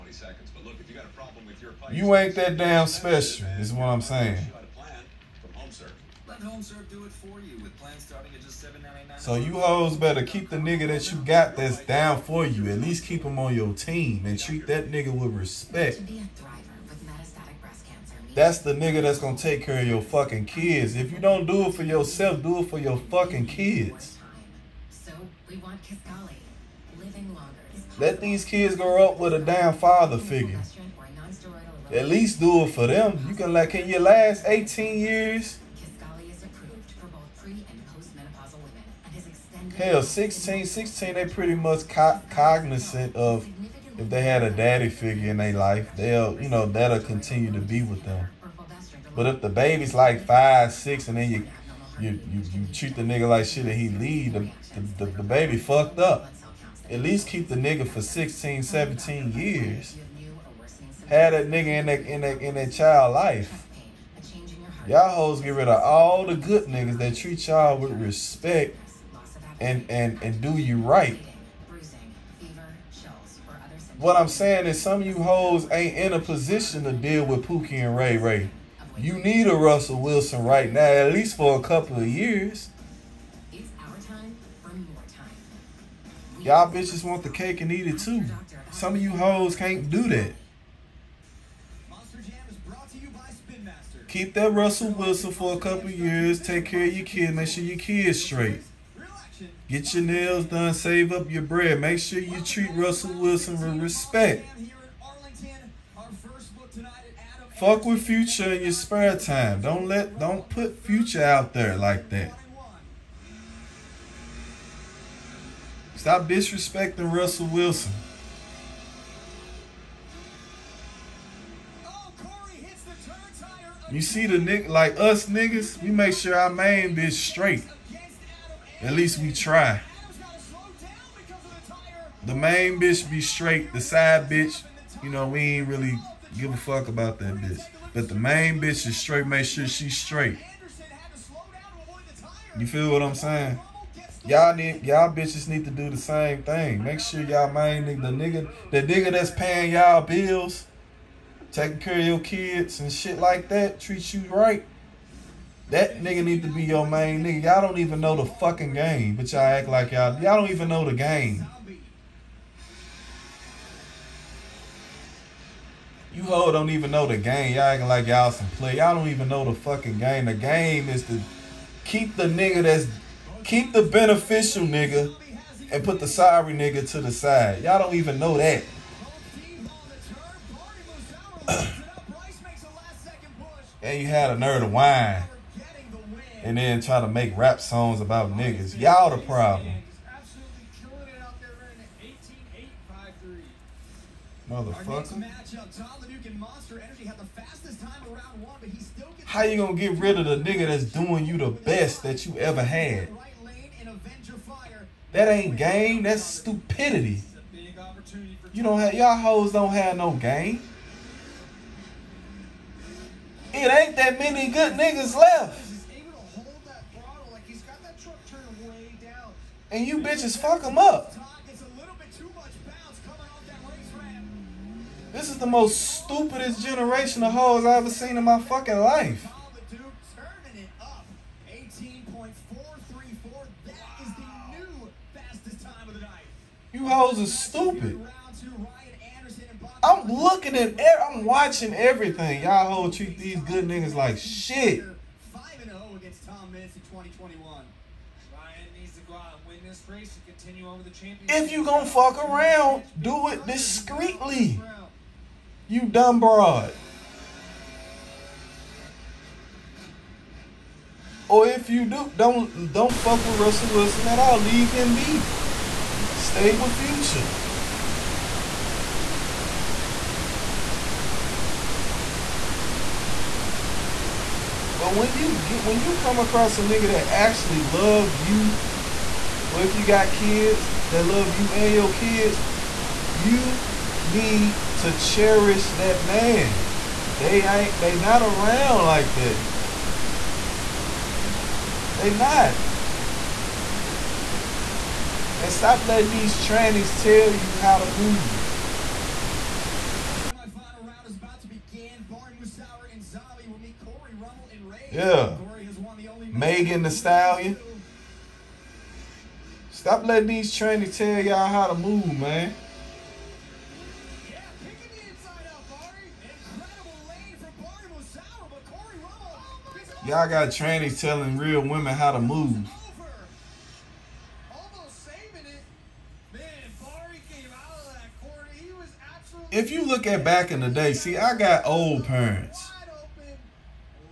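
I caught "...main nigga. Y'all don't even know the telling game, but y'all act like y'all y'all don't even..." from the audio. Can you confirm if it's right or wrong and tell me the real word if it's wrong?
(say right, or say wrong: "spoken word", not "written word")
wrong: "fucking", not "telling".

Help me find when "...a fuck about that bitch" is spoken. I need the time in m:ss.
2:16.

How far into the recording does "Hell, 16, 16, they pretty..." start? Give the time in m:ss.
0:39.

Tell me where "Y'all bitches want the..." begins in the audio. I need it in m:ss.
1:26.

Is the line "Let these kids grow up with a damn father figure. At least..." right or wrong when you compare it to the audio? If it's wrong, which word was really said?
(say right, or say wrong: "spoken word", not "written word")
right.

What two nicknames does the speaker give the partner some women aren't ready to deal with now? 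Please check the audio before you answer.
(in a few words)
Pookie and Ray Ray.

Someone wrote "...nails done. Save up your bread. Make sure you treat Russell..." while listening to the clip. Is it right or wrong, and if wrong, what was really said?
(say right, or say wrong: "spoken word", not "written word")
right.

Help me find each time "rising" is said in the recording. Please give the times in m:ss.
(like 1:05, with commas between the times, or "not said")
not said.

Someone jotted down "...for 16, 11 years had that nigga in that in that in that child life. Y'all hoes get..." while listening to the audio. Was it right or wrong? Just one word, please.
wrong.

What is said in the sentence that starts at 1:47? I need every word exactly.
Fuck with Future in your spare time.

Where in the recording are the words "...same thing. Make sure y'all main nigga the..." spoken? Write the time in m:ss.
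2:25.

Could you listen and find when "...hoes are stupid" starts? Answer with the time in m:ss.
3:56.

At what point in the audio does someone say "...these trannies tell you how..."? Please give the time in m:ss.
4:56.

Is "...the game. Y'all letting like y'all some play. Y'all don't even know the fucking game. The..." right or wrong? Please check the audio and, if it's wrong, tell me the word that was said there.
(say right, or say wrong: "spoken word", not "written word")
wrong: "acting", not "letting".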